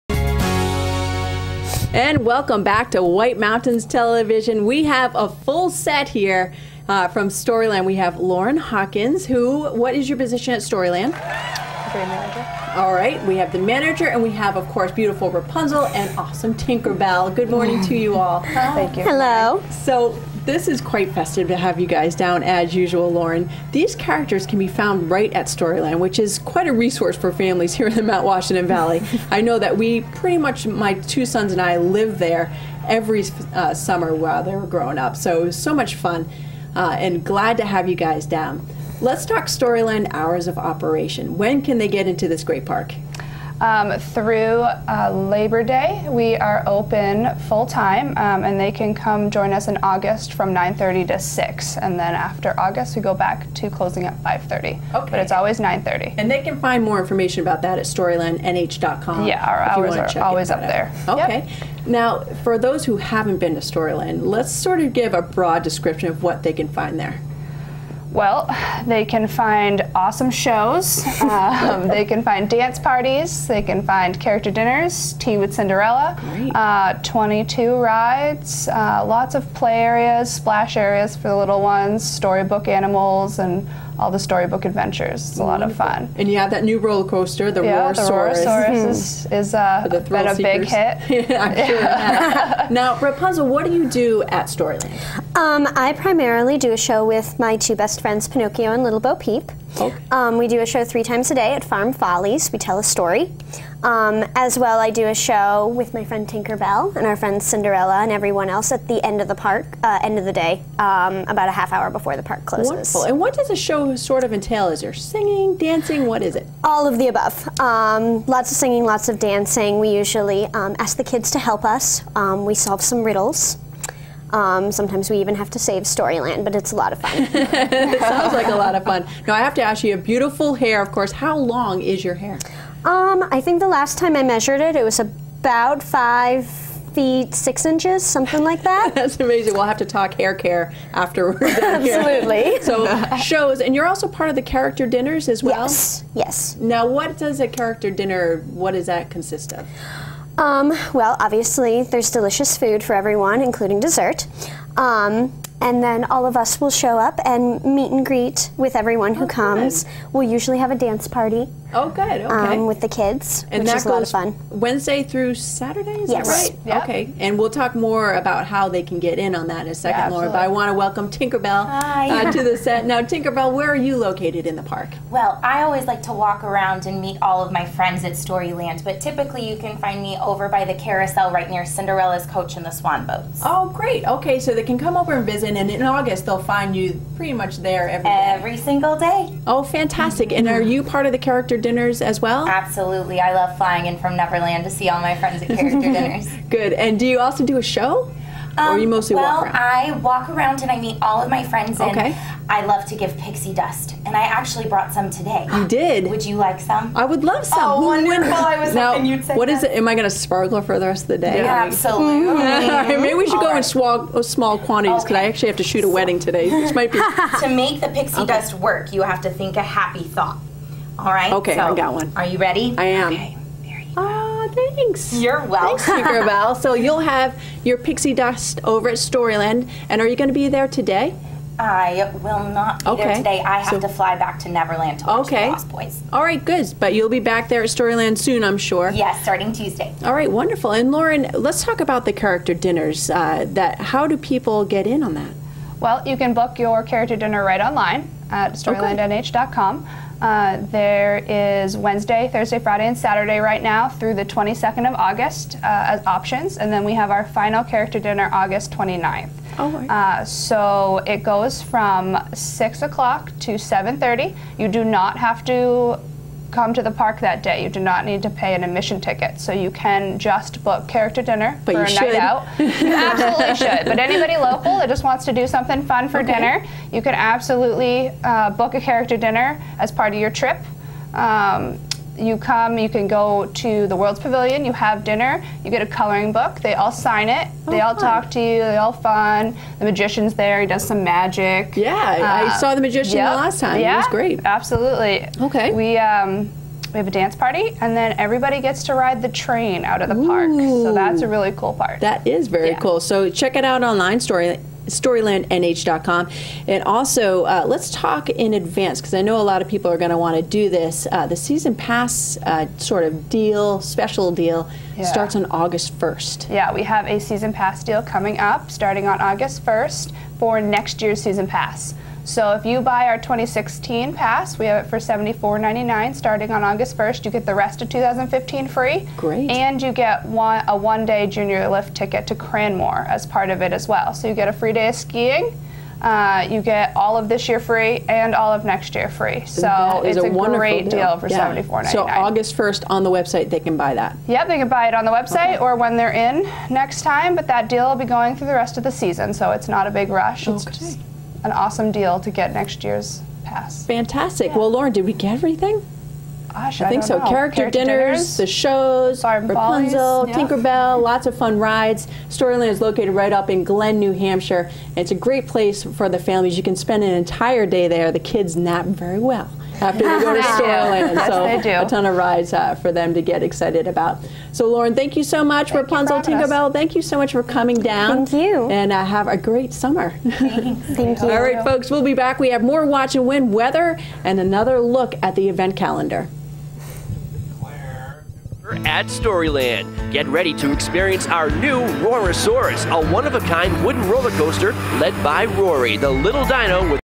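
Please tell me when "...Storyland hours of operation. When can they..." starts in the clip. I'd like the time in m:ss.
0:39.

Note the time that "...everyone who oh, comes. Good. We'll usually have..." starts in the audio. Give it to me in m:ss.
2:38.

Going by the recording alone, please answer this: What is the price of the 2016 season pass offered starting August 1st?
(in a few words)
$74.99.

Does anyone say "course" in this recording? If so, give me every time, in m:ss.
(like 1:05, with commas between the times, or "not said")
0:14, 2:10.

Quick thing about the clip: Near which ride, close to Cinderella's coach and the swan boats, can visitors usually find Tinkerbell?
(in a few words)
The carousel.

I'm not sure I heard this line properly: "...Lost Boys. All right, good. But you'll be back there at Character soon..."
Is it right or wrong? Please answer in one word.
wrong.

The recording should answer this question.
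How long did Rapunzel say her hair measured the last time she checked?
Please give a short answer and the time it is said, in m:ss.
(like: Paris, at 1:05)
5 feet 6 inches, at 2:15.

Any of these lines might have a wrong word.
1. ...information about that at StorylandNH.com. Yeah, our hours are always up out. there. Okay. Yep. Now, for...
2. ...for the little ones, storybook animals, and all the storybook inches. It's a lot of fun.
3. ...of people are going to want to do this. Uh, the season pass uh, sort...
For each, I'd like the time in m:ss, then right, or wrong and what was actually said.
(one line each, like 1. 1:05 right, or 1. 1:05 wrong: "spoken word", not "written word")
1. 0:56 right
2. 1:21 wrong: "adventures", not "inches"
3. 5:09 right.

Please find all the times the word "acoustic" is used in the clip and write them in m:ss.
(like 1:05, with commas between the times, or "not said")
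not said.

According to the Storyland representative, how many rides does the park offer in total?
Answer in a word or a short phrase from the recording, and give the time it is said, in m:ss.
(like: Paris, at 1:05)
22, at 1:17.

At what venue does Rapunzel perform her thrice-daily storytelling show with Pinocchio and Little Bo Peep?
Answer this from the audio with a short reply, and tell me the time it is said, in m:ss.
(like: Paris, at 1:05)
Farm Follies, at 1:41.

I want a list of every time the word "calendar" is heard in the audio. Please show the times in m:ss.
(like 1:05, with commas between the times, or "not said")
6:25.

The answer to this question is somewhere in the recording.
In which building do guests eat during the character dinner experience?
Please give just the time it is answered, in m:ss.
4:43.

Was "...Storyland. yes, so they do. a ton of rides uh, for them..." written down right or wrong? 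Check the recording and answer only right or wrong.
right.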